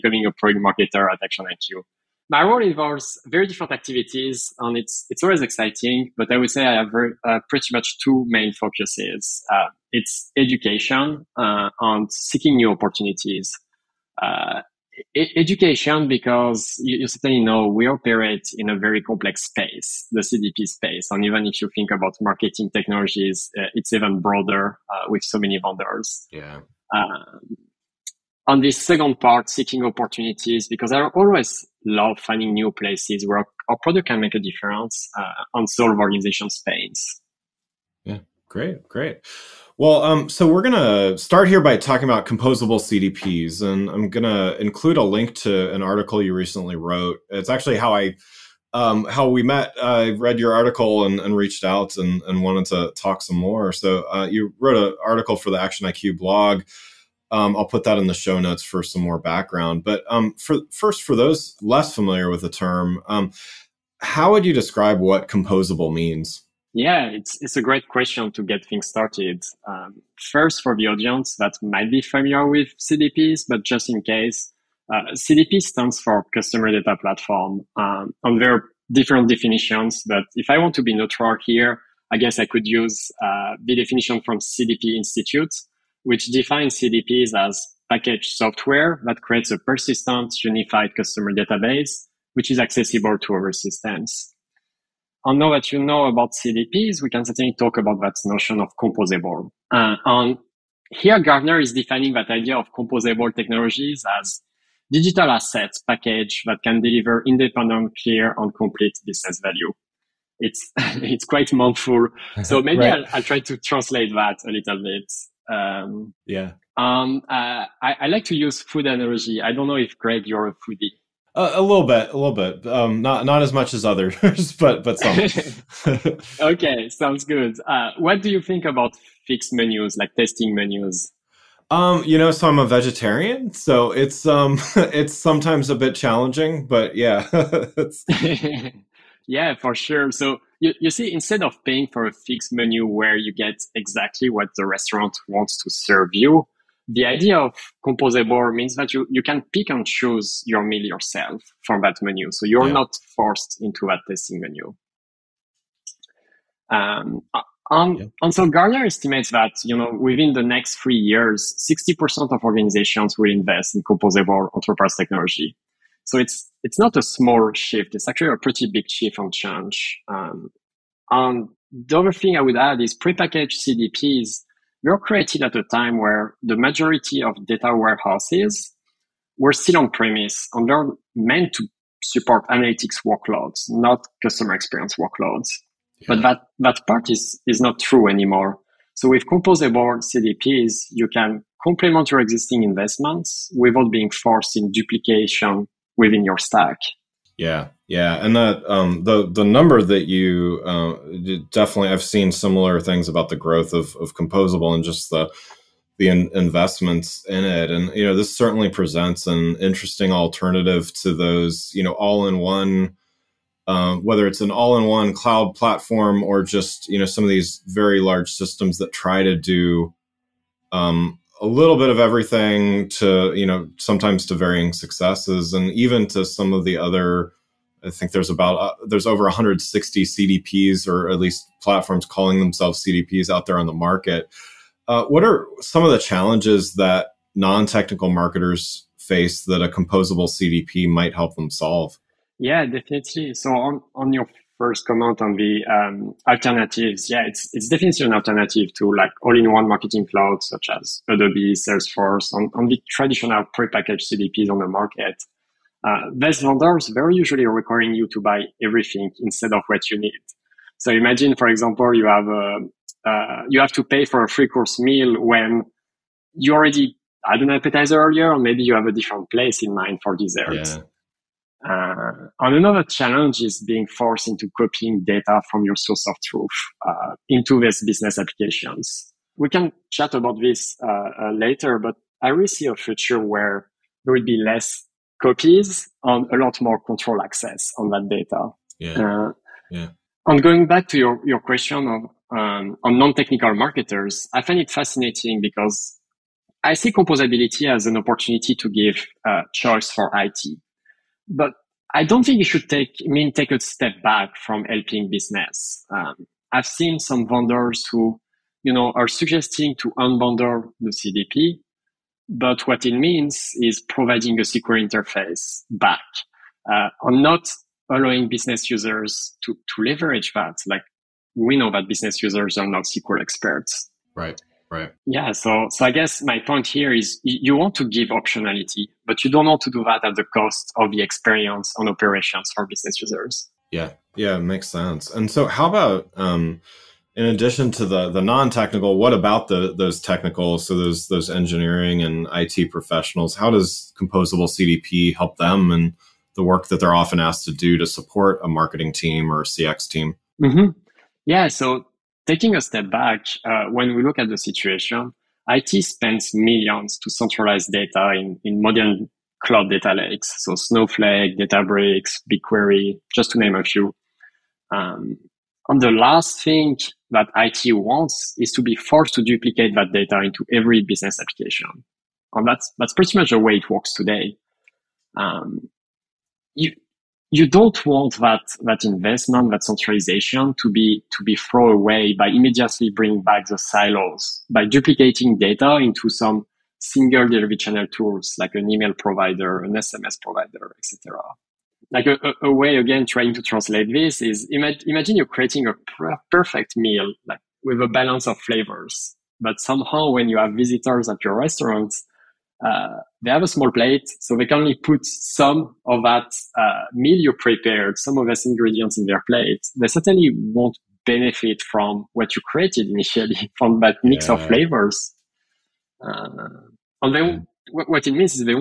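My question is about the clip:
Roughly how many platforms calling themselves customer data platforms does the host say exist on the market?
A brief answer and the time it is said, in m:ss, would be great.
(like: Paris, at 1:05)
Over 160, at 3:49.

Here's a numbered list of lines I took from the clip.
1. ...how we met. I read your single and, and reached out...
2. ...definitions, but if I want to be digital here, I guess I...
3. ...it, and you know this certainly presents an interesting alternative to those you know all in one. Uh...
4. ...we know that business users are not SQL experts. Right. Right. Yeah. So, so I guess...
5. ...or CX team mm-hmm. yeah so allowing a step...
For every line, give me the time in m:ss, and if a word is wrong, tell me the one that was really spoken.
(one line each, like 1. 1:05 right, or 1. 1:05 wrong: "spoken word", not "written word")
1. 0:49 wrong: "article", not "single"
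2. 1:19 wrong: "neutral", not "digital"
3. 3:27 right
4. 5:21 right
5. 5:49 wrong: "taking", not "allowing".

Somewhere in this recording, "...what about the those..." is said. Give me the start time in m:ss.
5:38.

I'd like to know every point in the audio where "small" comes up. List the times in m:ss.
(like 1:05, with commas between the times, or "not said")
2:47, 6:43.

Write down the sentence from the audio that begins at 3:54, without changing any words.
Uh, what are some of the challenges that non-technical marketers face that a composable CDP might help them solve?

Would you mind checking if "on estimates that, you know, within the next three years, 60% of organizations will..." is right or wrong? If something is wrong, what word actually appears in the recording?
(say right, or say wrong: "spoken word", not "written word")
right.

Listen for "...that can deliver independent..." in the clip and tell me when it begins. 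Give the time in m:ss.
1:46.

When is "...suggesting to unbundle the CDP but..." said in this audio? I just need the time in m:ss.
5:09.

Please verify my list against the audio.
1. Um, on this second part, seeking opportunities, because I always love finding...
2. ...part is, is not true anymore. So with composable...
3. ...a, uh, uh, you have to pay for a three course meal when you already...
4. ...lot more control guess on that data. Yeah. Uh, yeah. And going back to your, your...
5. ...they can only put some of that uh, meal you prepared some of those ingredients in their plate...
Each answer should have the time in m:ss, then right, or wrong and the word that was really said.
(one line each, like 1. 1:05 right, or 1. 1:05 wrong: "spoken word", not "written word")
1. 0:26 right
2. 3:06 right
3. 4:22 right
4. 4:46 wrong: "access", not "guess"
5. 6:44 right.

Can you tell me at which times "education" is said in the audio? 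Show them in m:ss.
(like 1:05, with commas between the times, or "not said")
0:10, 0:15.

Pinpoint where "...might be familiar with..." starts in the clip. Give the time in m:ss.
1:11.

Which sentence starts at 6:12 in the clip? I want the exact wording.
And that's, that's pretty much the way it works today.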